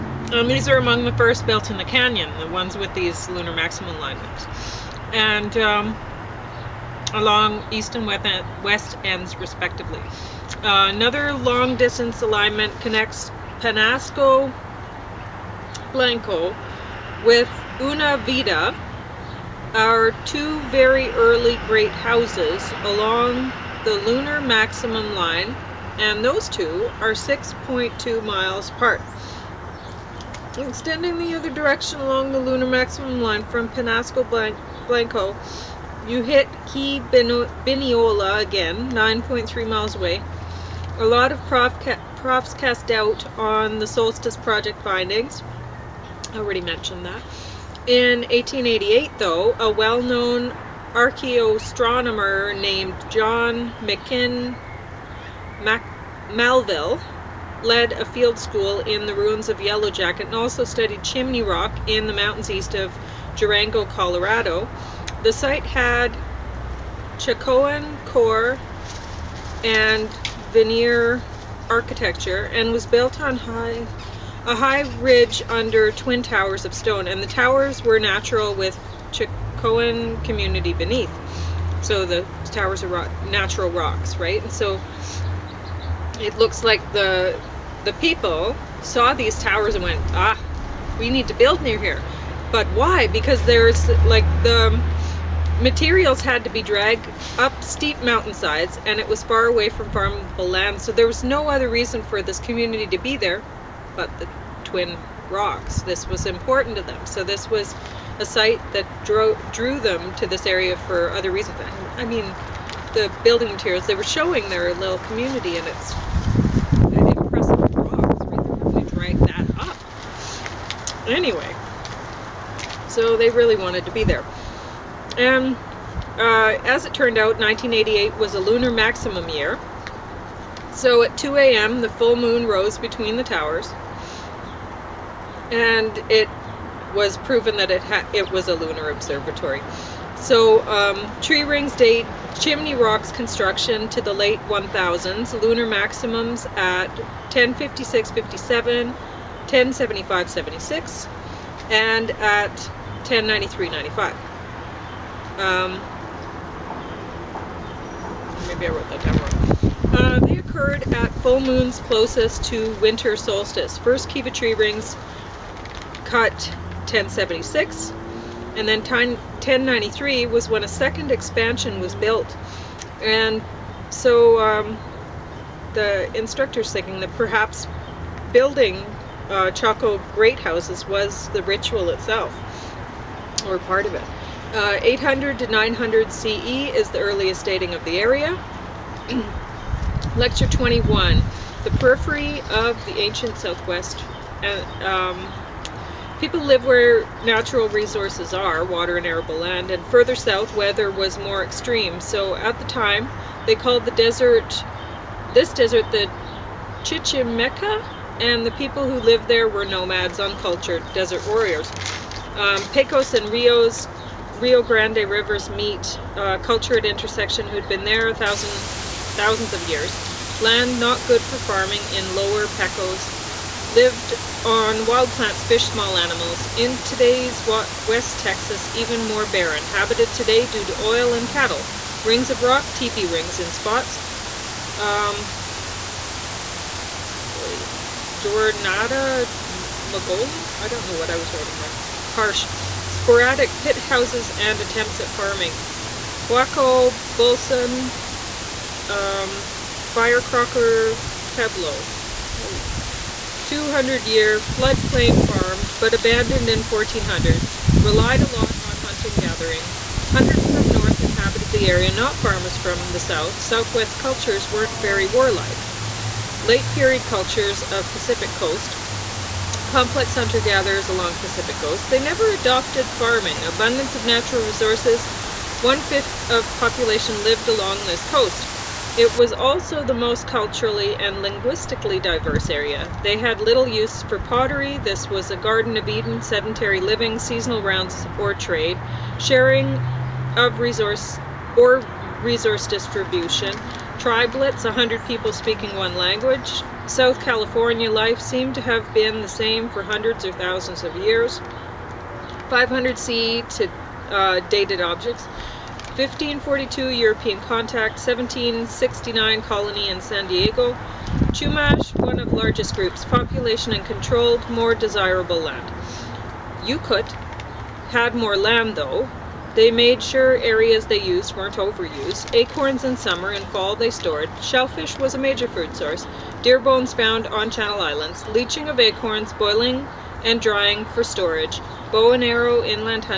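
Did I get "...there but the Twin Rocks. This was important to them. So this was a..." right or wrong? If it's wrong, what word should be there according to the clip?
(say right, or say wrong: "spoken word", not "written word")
right.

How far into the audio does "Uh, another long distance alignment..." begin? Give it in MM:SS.
00:10.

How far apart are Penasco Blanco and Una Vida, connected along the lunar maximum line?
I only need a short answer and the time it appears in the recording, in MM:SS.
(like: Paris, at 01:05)
6.2 miles, at 00:27.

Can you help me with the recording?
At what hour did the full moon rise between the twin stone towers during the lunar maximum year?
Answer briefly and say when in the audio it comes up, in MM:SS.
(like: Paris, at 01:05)
2 a.m., at 02:11.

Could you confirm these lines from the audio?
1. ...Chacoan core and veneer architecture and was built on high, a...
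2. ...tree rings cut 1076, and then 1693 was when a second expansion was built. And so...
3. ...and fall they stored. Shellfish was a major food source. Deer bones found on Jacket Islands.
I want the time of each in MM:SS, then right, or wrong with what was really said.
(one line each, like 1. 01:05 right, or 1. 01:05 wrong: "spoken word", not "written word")
1. 01:07 right
2. 02:44 wrong: "1093", not "1693"
3. 05:23 wrong: "Channel", not "Jacket".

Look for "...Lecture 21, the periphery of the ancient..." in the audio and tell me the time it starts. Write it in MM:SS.
03:10.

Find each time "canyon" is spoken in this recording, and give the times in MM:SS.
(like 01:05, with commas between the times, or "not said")
00:01.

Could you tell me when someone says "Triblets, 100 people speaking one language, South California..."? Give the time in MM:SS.
04:53.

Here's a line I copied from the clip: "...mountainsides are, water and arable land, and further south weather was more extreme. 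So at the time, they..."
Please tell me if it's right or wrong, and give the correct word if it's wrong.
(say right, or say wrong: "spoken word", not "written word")
wrong: "resources", not "mountainsides".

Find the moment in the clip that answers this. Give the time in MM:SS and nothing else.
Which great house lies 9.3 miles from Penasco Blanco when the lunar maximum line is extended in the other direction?
00:36.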